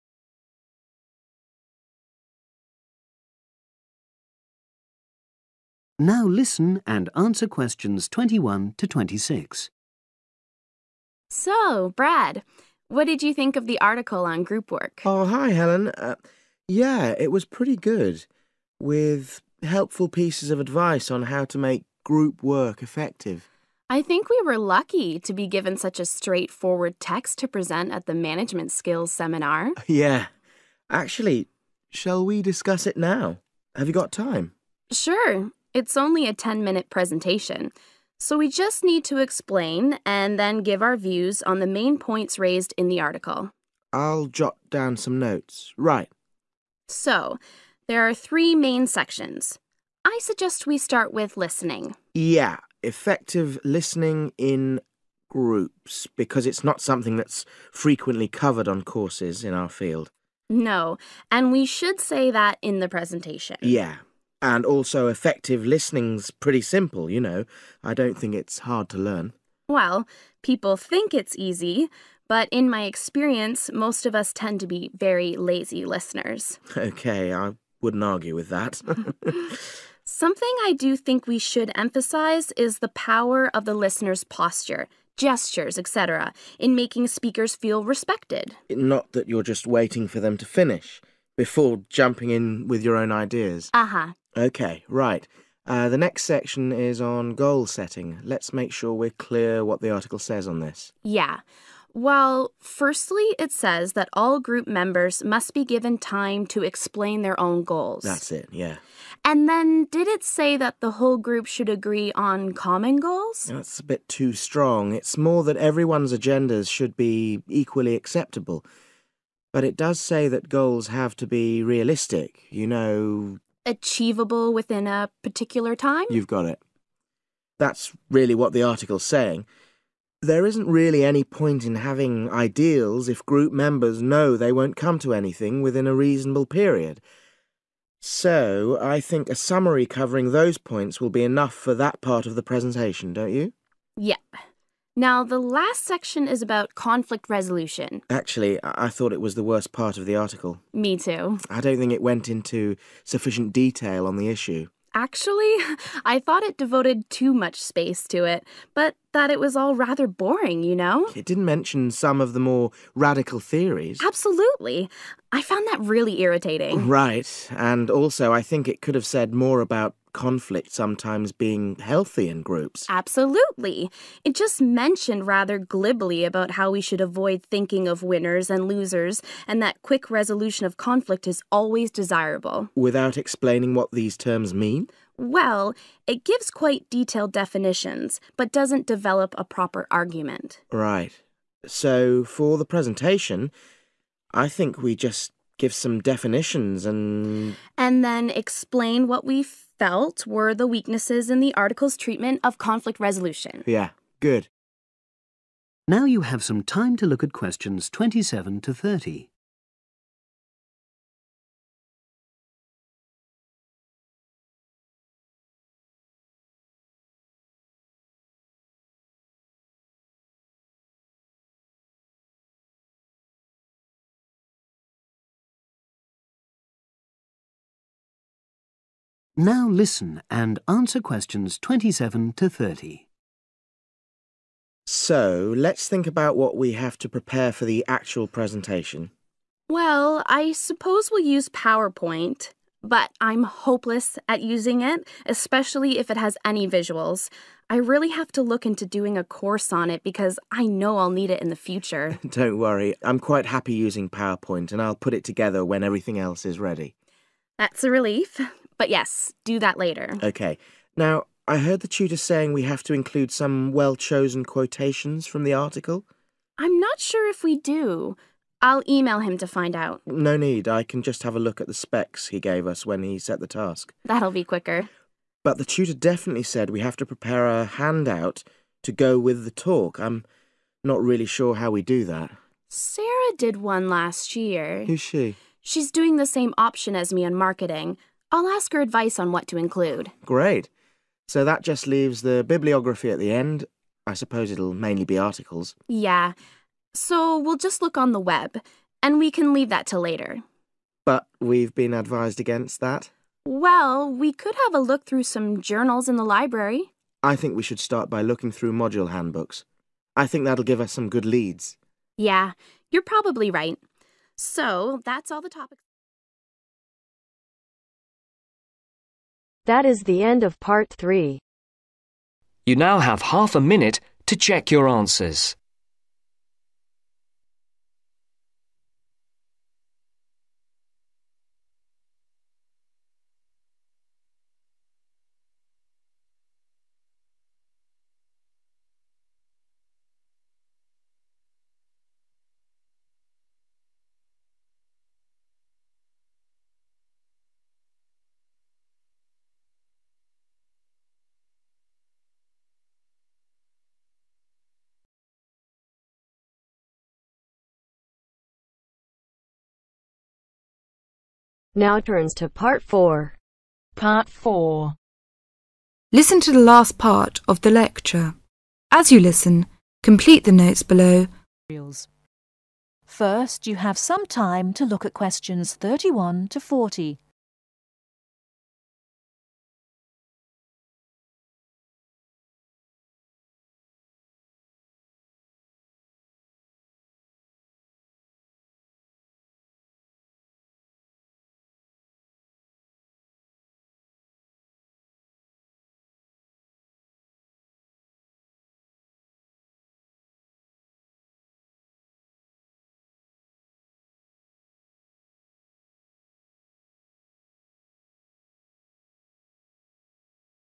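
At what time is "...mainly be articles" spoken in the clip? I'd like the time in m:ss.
4:54.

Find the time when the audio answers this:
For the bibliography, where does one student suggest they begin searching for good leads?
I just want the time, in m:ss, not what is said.
5:08.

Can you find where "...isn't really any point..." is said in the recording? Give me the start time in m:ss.
2:10.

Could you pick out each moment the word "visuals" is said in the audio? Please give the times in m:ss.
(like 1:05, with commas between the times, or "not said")
4:06.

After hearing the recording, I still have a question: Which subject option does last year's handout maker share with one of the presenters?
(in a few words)
marketing.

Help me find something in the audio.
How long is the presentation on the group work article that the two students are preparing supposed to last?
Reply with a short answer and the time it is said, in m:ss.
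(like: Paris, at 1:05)
10 minutes, at 0:36.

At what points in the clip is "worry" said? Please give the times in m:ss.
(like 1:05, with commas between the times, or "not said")
4:12.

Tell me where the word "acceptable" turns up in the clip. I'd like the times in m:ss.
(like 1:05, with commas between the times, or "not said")
1:57.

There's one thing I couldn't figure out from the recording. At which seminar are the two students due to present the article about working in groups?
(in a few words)
Management Skills Seminar.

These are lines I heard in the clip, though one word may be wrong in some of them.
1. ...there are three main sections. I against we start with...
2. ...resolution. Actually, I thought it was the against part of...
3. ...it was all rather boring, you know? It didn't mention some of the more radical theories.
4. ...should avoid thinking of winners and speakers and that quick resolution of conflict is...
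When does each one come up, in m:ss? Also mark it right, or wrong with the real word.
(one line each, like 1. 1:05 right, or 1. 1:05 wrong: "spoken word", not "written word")
1. 0:47 wrong: "suggest", not "against"
2. 2:27 wrong: "worst", not "against"
3. 2:39 right
4. 2:56 wrong: "losers", not "speakers".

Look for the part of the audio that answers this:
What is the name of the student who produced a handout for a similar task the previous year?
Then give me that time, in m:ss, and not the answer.
4:42.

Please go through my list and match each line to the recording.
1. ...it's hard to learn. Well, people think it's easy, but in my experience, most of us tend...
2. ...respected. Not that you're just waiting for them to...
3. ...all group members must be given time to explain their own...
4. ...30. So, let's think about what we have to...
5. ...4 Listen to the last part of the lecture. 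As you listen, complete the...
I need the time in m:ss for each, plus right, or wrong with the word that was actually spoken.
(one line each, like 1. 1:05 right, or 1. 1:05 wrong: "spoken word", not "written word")
1. 1:08 right
2. 1:27 right
3. 1:44 right
4. 3:52 right
5. 6:04 right.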